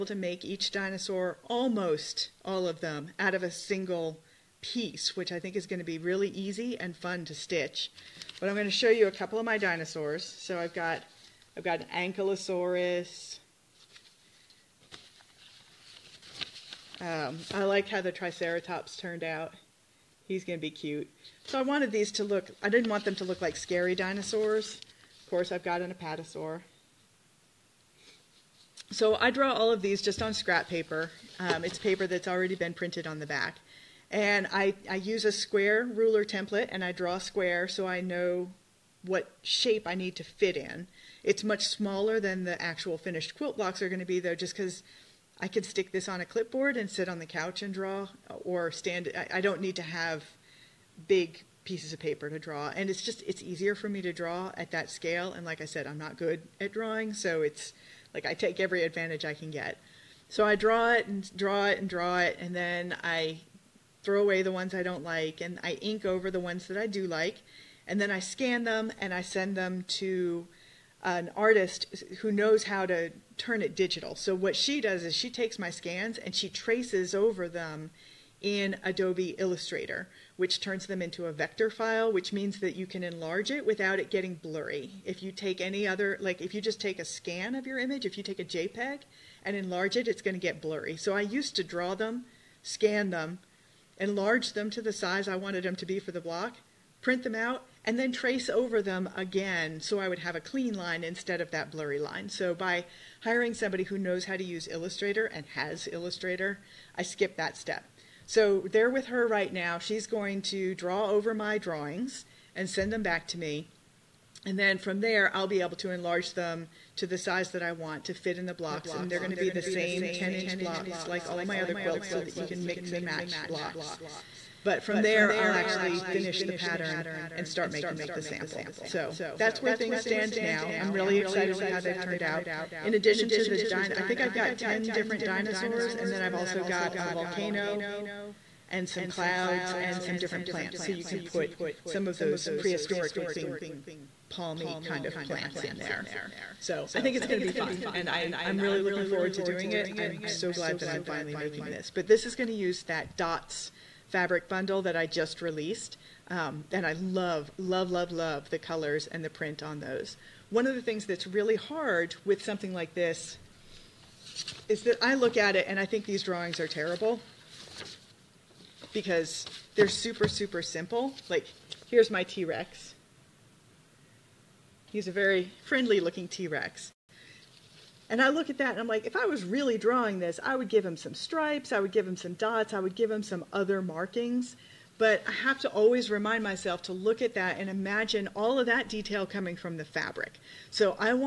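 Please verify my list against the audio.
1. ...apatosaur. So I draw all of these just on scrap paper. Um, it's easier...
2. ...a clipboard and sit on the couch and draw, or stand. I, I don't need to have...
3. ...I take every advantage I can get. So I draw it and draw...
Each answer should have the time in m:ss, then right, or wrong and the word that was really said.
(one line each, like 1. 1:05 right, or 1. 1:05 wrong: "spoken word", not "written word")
1. 0:25 wrong: "paper", not "easier"
2. 0:46 right
3. 0:58 right.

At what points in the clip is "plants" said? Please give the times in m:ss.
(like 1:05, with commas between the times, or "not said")
2:20, 2:25.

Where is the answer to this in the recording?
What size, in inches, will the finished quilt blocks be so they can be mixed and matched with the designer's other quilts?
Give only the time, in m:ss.
2:00.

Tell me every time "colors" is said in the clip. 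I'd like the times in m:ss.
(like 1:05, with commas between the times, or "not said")
2:38.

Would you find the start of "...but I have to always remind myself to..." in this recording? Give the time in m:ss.
3:04.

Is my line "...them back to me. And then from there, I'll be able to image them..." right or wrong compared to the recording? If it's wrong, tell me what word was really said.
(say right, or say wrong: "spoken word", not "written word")
wrong: "enlarge", not "image".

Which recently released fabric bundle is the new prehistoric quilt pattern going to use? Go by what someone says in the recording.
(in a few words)
dots fabric bundle.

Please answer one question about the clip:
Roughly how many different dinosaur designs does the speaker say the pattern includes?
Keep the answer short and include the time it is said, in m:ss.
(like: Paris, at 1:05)
10, at 2:14.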